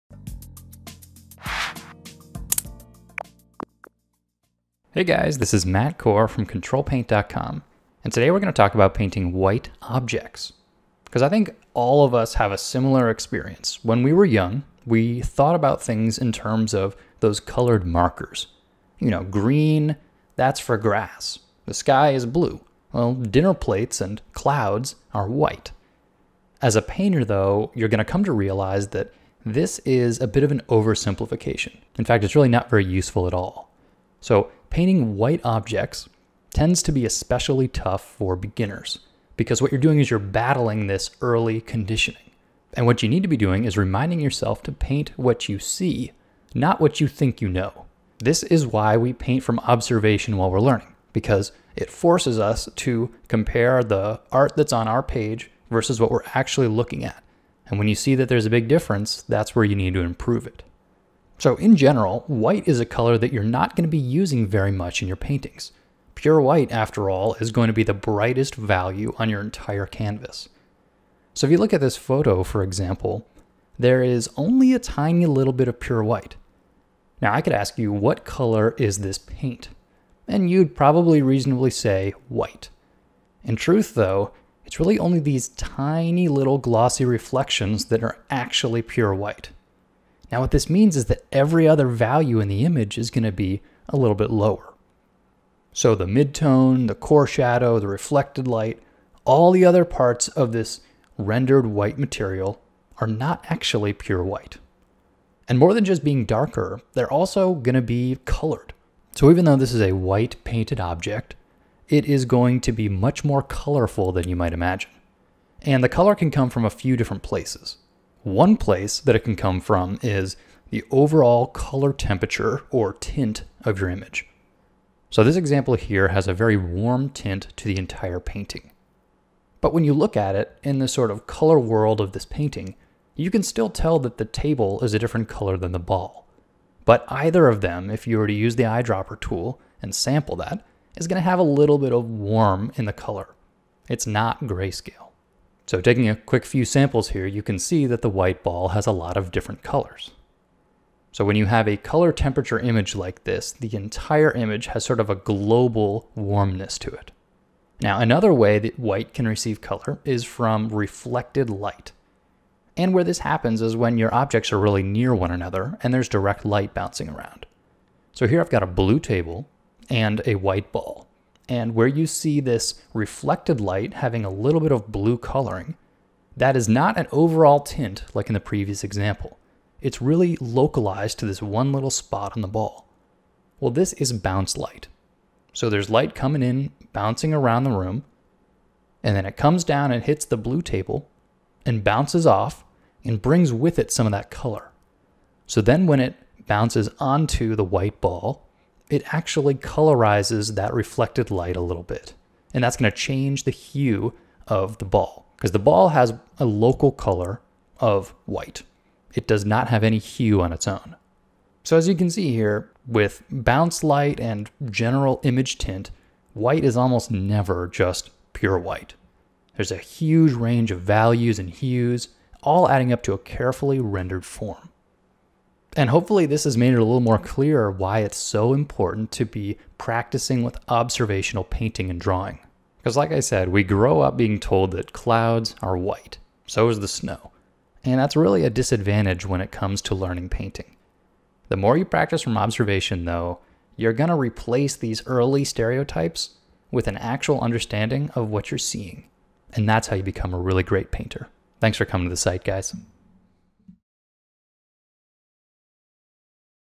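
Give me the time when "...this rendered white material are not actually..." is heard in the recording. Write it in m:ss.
1:40.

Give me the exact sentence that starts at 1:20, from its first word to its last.
And you'd probably reasonably say white.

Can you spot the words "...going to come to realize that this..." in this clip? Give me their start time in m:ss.
0:27.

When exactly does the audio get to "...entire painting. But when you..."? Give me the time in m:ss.
2:07.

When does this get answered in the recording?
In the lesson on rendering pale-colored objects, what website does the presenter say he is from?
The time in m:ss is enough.
0:06.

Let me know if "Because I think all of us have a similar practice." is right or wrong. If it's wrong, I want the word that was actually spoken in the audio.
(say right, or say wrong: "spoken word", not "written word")
wrong: "experience", not "practice".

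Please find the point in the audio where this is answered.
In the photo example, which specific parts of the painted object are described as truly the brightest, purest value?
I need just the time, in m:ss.
1:25.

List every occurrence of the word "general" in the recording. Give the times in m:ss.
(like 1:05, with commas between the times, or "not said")
1:01, 3:34.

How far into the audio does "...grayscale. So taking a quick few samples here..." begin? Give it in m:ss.
2:24.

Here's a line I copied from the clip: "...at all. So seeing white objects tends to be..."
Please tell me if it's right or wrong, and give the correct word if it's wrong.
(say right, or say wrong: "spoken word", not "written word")
wrong: "painting", not "seeing".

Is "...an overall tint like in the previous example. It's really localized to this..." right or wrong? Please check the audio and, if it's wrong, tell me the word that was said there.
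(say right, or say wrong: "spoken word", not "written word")
right.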